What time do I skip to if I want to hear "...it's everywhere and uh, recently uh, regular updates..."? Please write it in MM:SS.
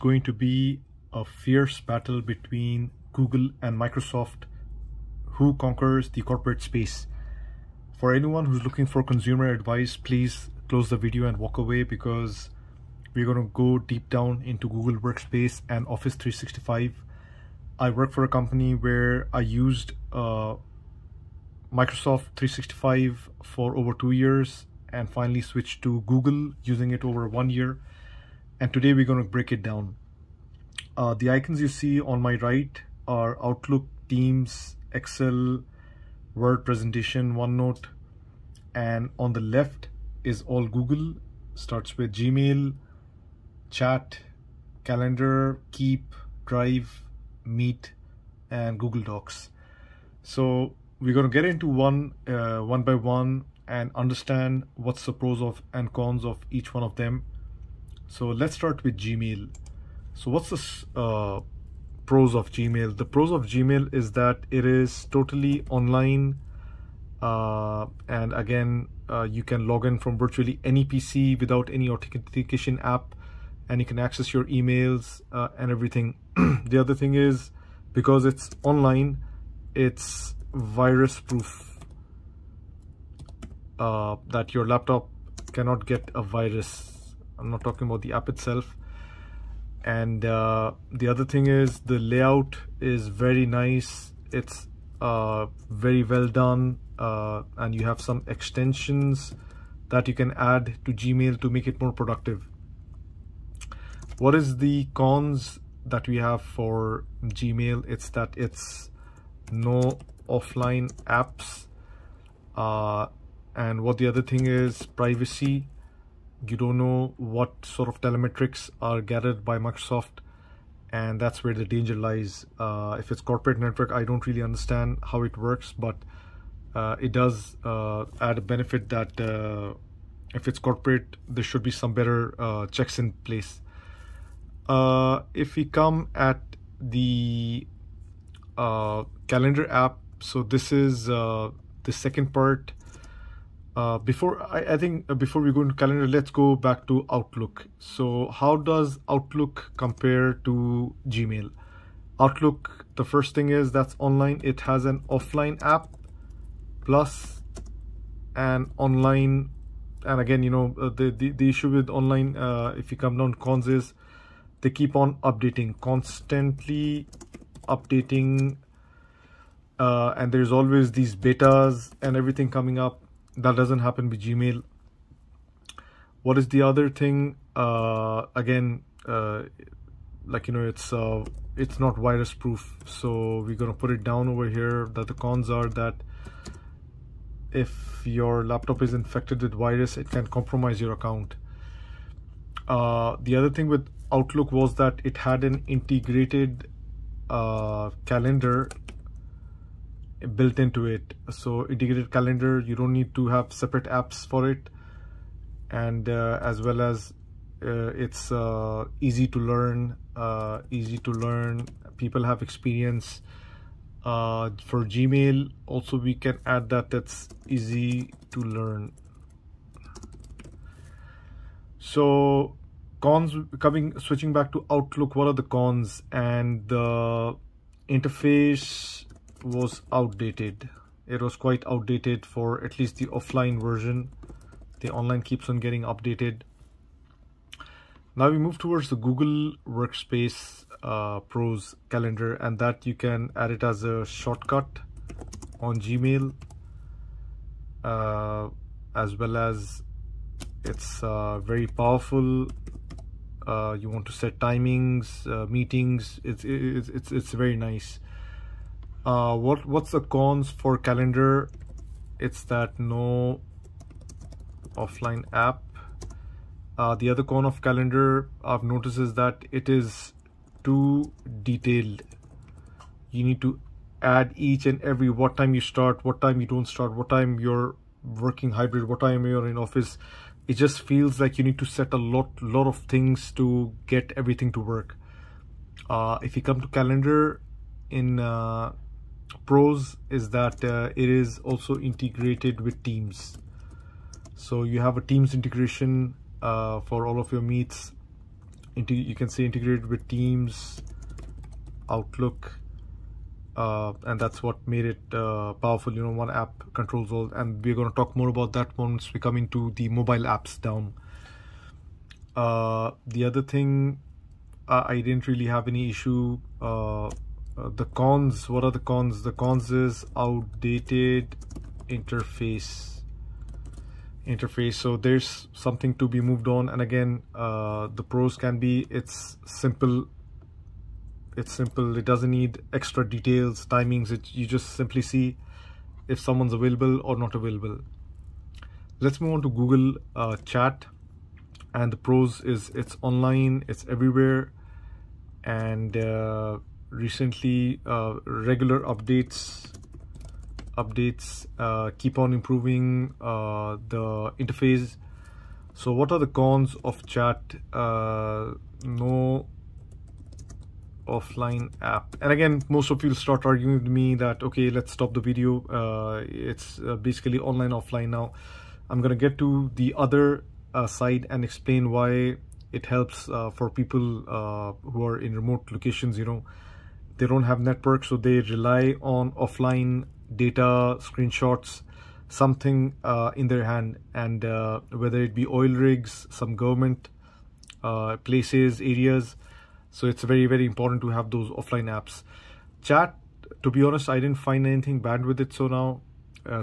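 05:43.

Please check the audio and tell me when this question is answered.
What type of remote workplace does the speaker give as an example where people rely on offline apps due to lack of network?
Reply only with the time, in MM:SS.
06:25.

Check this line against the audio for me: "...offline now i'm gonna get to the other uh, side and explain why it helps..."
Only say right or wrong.
right.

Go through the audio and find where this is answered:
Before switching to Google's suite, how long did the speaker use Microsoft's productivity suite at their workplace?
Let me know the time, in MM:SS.
00:23.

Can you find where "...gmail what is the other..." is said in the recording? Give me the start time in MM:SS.
02:54.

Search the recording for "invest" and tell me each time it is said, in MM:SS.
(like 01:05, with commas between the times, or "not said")
not said.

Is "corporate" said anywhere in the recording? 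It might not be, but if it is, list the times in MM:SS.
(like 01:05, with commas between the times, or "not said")
00:06, 02:03, 02:10.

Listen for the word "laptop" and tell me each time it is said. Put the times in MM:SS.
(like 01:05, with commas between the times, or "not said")
01:24, 03:08.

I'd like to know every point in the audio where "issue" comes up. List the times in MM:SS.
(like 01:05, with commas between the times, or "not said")
02:41, 05:15.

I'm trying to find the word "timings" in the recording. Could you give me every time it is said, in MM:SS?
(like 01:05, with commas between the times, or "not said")
04:14, 05:33.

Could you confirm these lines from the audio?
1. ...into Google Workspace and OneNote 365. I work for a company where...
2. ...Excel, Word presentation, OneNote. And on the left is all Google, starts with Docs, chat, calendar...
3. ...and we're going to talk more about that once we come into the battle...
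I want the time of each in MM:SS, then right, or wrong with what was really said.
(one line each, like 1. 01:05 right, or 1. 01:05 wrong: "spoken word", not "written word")
1. 00:14 wrong: "Office", not "OneNote"
2. 00:34 wrong: "Gmail", not "Docs"
3. 05:07 wrong: "mobile", not "battle".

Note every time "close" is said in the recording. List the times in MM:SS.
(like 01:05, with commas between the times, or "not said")
00:10.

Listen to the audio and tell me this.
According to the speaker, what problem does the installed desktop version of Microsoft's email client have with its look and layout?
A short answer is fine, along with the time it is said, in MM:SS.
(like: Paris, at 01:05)
outdated interface, at 03:46.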